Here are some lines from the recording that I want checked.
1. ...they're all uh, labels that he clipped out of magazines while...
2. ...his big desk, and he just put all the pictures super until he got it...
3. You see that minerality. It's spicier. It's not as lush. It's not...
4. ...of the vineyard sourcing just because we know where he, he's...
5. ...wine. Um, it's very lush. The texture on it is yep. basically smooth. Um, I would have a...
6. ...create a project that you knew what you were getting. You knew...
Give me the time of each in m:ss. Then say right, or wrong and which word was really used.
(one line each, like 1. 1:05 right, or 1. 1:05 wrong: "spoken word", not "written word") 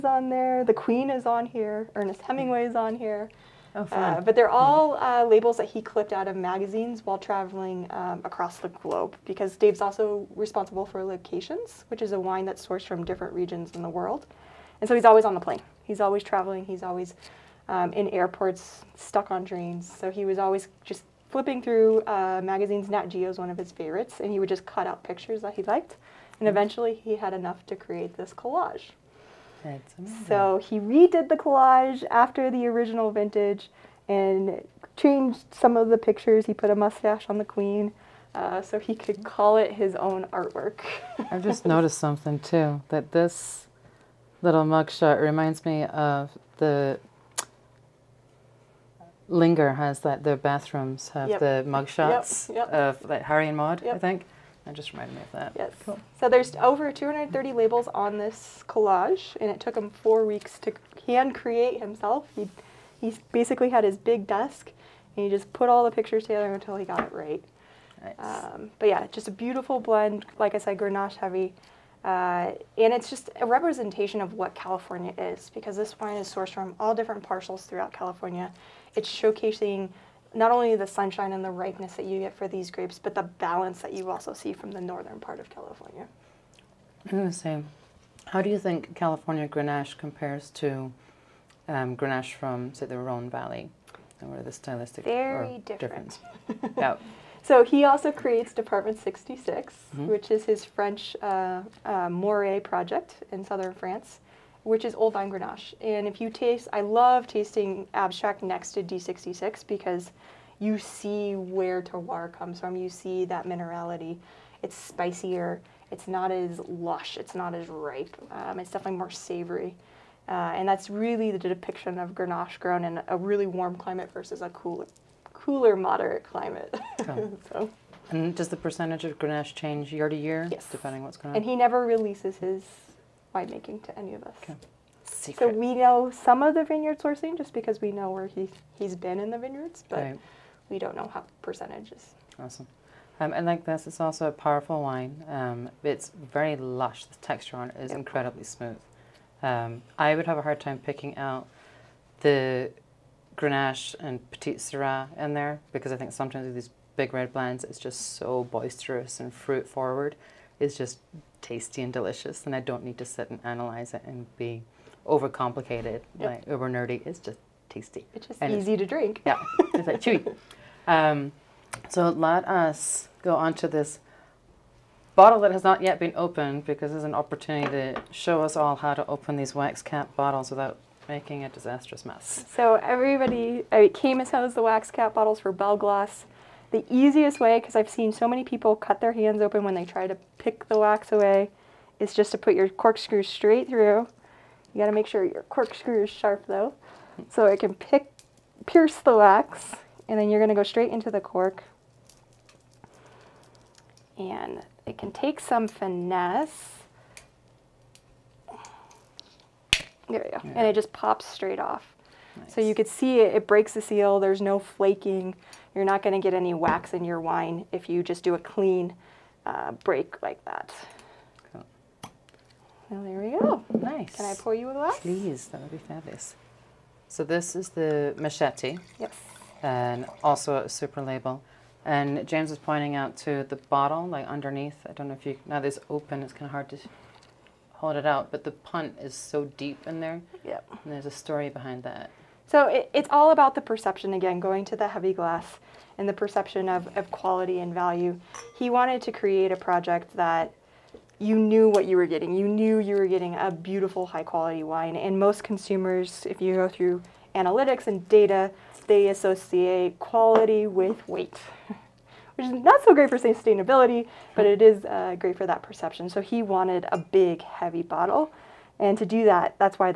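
1. 0:04 right
2. 1:03 wrong: "together", not "super"
3. 1:52 right
4. 2:16 right
5. 2:24 wrong: "incredibly", not "basically"
6. 4:09 right.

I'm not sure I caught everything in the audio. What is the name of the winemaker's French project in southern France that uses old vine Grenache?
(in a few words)
Department 66.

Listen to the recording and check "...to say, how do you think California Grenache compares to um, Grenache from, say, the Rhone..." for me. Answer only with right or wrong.
right.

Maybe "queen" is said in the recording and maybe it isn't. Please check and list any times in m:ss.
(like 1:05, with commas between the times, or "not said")
0:00, 0:37.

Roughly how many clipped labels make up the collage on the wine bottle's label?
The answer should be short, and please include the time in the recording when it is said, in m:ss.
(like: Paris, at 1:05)
over 230, at 0:56.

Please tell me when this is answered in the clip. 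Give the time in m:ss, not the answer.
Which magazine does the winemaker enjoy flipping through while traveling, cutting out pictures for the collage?
0:22.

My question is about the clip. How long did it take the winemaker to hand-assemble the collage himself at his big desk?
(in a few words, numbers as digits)
4 weeks.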